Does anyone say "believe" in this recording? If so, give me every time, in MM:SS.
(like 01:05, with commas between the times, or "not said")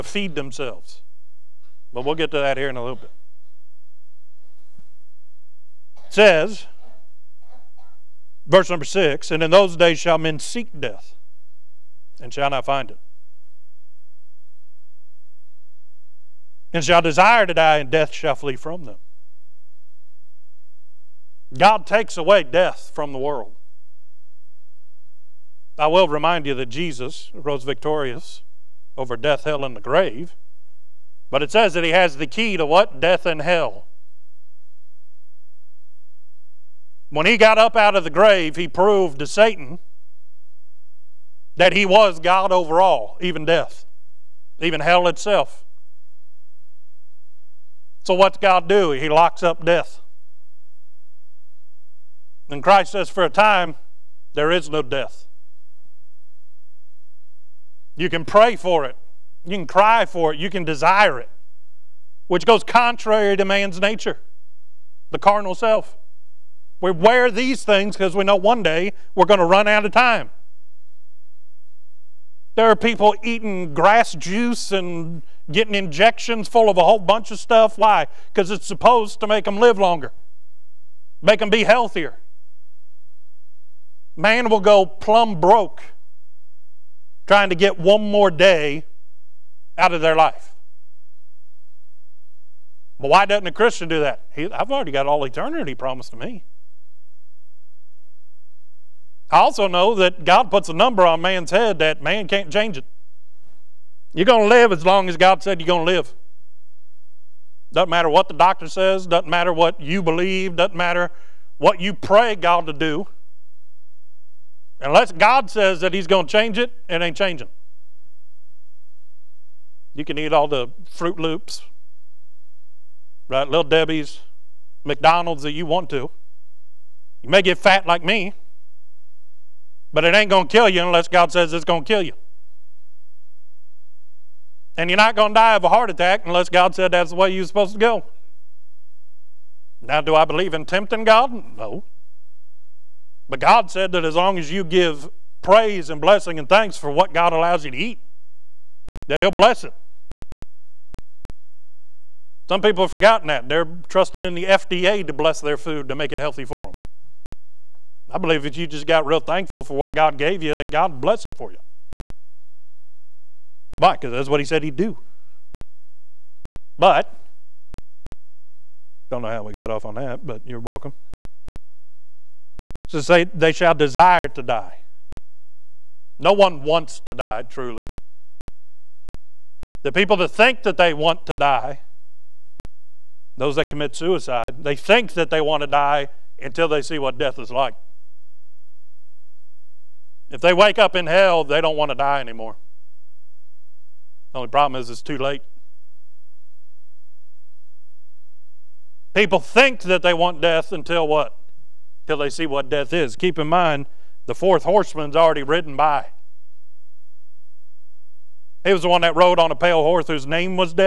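01:50, 02:20, 02:38.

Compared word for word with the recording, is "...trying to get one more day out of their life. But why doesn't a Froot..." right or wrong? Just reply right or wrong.
wrong.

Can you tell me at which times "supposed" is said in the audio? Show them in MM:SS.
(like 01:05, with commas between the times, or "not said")
01:18, 02:17.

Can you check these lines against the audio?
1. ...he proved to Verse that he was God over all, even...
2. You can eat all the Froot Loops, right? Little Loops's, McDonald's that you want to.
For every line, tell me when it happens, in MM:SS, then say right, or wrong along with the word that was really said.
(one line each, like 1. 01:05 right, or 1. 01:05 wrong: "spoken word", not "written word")
1. 00:38 wrong: "Satan", not "Verse"
2. 01:59 wrong: "Debbie", not "Loops".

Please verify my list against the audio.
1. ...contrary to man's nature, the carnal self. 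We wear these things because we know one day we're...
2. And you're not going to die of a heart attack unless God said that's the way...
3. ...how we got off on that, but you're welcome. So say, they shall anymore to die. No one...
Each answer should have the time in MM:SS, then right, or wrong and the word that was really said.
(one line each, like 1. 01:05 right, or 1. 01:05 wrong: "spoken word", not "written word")
1. 01:02 right
2. 02:14 right
3. 02:49 wrong: "desire", not "anymore".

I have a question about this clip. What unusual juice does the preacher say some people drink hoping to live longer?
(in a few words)
Grass juice.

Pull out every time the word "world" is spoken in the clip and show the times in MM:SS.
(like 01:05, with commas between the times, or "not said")
00:23.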